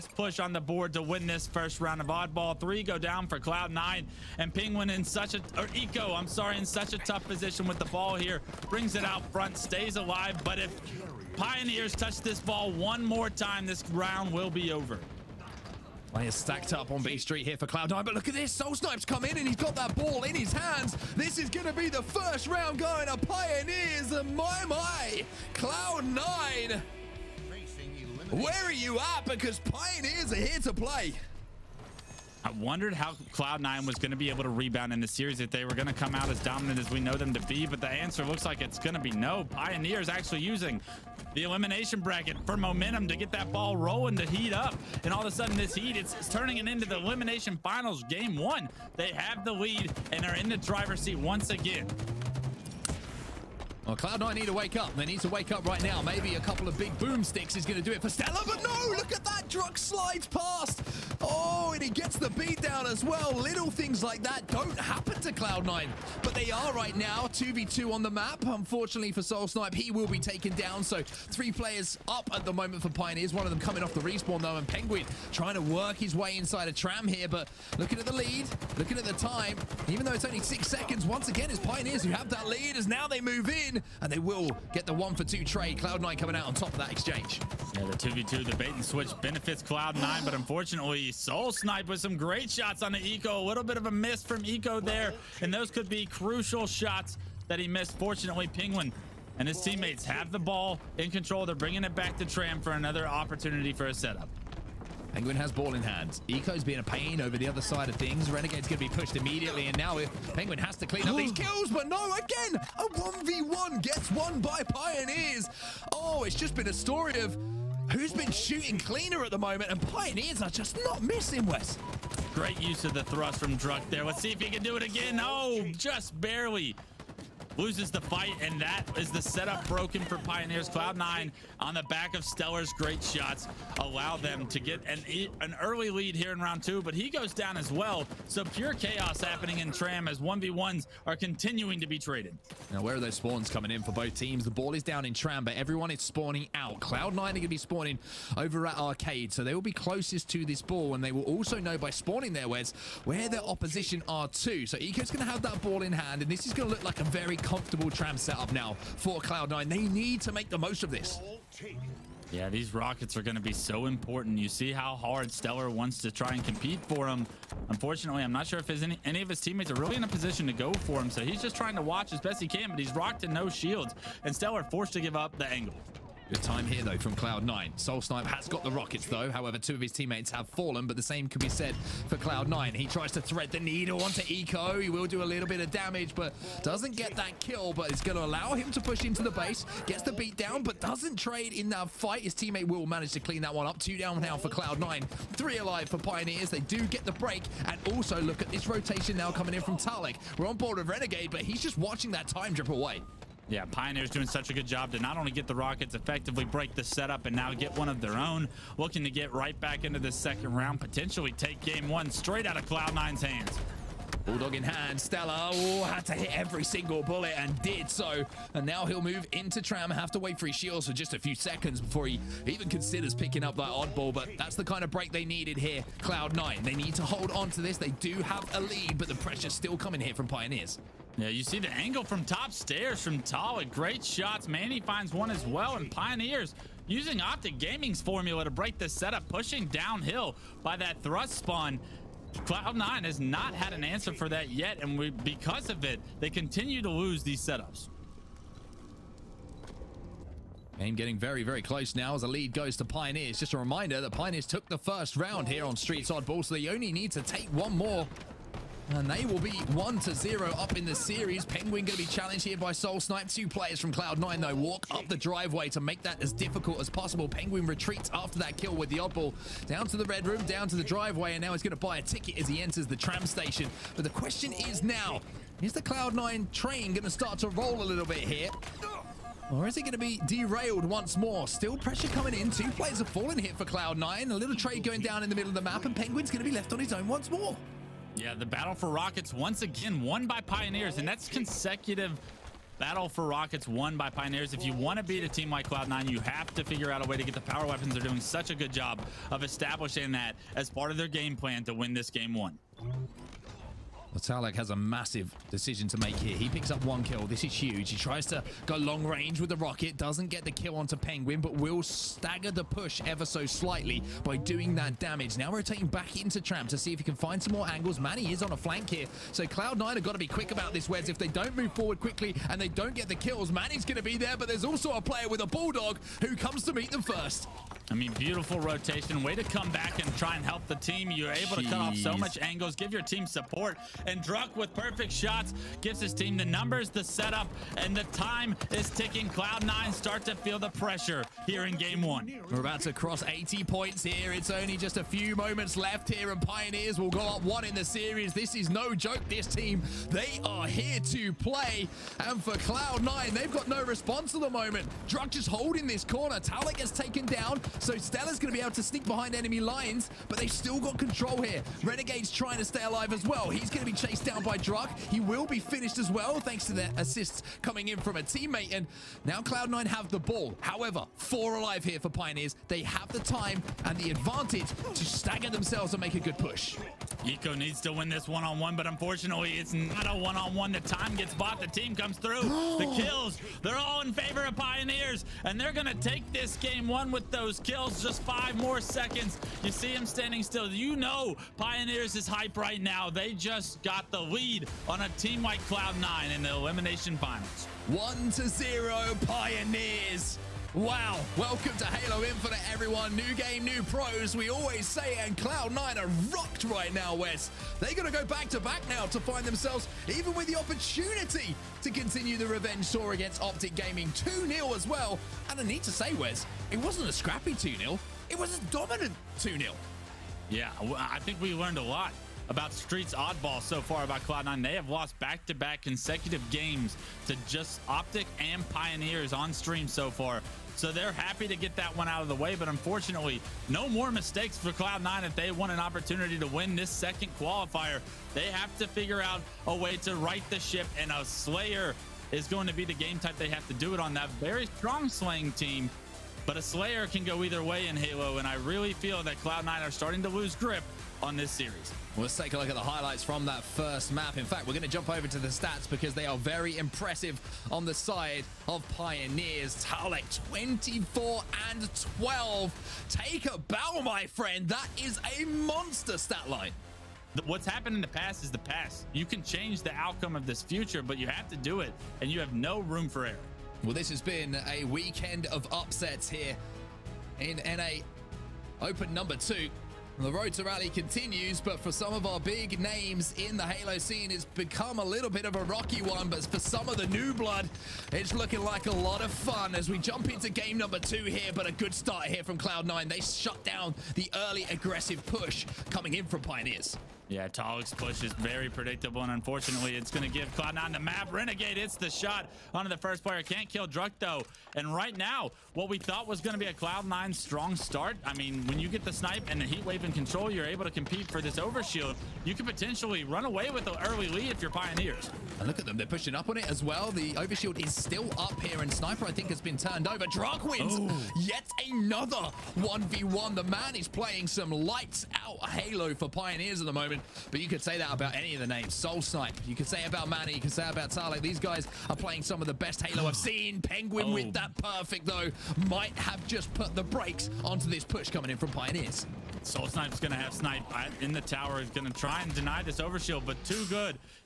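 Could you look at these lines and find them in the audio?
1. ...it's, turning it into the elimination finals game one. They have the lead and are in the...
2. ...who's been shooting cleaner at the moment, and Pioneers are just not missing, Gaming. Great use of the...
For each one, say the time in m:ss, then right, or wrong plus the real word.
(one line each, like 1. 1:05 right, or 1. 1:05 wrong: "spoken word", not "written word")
1. 0:46 right
2. 1:57 wrong: "Wes", not "Gaming".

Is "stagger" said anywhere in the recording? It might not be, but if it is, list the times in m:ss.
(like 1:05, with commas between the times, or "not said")
5:11, 6:15.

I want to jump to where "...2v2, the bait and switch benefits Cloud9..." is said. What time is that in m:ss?
1:27.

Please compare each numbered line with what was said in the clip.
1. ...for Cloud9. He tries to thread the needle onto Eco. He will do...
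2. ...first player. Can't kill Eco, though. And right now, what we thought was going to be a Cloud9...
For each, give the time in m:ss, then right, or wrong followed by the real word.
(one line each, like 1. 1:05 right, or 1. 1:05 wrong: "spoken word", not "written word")
1. 3:02 right
2. 8:22 wrong: "Druk", not "Eco".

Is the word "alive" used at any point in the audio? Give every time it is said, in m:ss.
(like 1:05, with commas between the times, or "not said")
0:09, 3:15, 6:02, 6:11.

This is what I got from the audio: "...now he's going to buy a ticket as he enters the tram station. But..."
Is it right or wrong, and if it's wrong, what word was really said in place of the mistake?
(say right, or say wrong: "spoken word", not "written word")
right.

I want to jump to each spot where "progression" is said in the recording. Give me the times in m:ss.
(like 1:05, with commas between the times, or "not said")
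not said.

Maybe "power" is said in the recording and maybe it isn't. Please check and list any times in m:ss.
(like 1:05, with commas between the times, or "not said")
4:57.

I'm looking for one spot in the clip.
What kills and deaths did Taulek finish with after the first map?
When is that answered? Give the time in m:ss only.
7:40.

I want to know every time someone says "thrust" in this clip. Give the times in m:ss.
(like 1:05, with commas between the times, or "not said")
2:03, 4:01.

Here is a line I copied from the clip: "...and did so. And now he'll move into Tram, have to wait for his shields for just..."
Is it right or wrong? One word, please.
right.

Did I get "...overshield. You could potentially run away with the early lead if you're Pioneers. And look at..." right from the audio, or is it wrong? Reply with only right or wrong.
right.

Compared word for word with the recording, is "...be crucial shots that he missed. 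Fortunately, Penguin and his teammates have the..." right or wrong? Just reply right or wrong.
right.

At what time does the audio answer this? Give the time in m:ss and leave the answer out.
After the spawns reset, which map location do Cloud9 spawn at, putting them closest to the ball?
2:28.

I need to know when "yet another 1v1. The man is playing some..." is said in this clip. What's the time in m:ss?
8:41.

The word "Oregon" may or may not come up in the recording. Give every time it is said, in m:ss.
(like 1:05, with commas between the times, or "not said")
not said.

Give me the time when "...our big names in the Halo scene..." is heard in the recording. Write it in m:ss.
8:02.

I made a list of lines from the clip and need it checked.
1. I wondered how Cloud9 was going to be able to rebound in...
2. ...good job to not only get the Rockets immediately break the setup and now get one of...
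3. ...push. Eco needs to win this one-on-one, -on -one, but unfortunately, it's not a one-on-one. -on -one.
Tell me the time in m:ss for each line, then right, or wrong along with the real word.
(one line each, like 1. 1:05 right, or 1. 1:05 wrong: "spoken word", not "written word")
1. 0:32 right
2. 3:24 wrong: "effectively", not "immediately"
3. 6:16 right.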